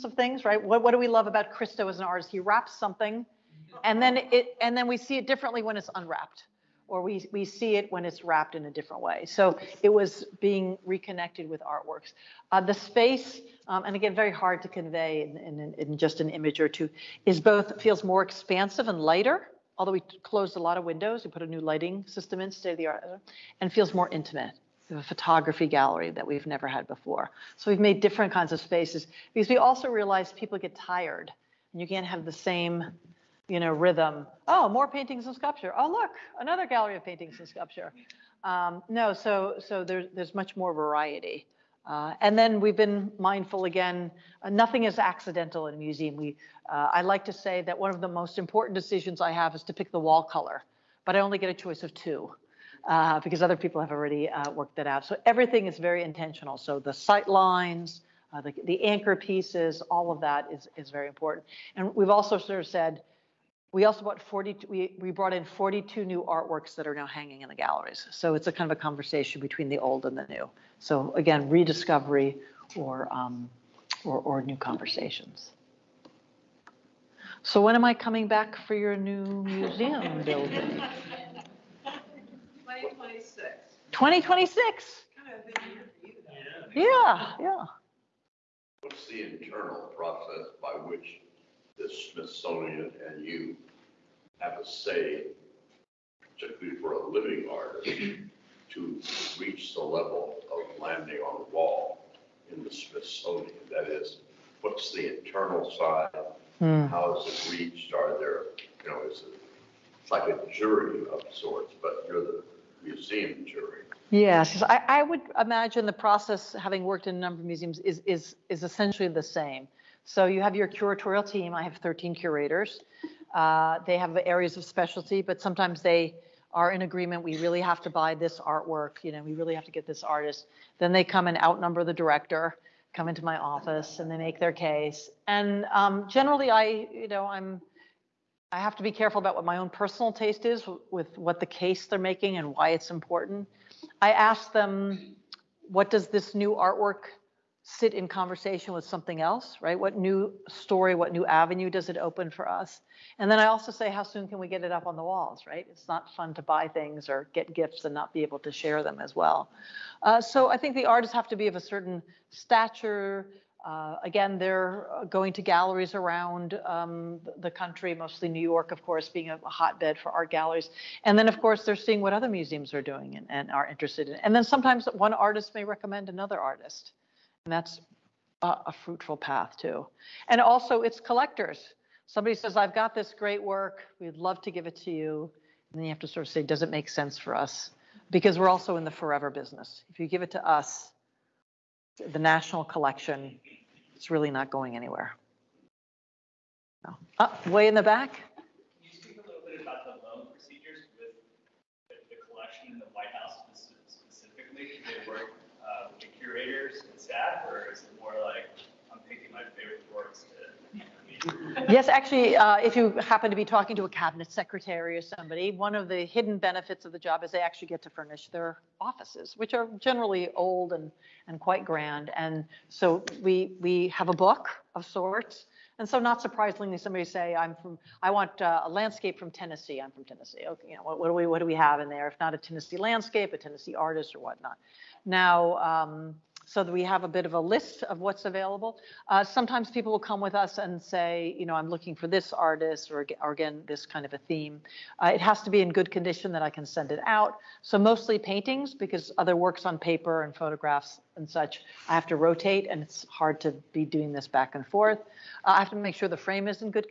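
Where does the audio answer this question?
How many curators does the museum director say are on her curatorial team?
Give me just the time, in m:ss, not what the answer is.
2:01.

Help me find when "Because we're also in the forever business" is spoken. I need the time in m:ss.
3:08.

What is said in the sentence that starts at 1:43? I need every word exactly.
That is, what's the internal side?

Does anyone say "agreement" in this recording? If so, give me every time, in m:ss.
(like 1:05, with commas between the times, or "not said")
2:06.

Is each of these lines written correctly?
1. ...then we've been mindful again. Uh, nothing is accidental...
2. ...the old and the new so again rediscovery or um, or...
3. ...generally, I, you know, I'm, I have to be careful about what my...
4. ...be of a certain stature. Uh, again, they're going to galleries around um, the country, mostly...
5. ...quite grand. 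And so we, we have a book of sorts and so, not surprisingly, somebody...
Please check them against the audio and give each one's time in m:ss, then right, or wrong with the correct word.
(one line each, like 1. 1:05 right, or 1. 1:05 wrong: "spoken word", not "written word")
1. 0:42 right
2. 1:09 right
3. 2:16 right
4. 2:41 right
5. 3:41 right.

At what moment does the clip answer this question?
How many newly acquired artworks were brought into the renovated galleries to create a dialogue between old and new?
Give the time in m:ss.
1:05.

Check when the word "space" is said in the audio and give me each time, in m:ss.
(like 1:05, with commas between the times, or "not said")
0:12, 0:28.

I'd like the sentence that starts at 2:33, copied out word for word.
And then I also say, how soon can we get it up on the walls, right?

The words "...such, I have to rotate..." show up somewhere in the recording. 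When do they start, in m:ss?
4:11.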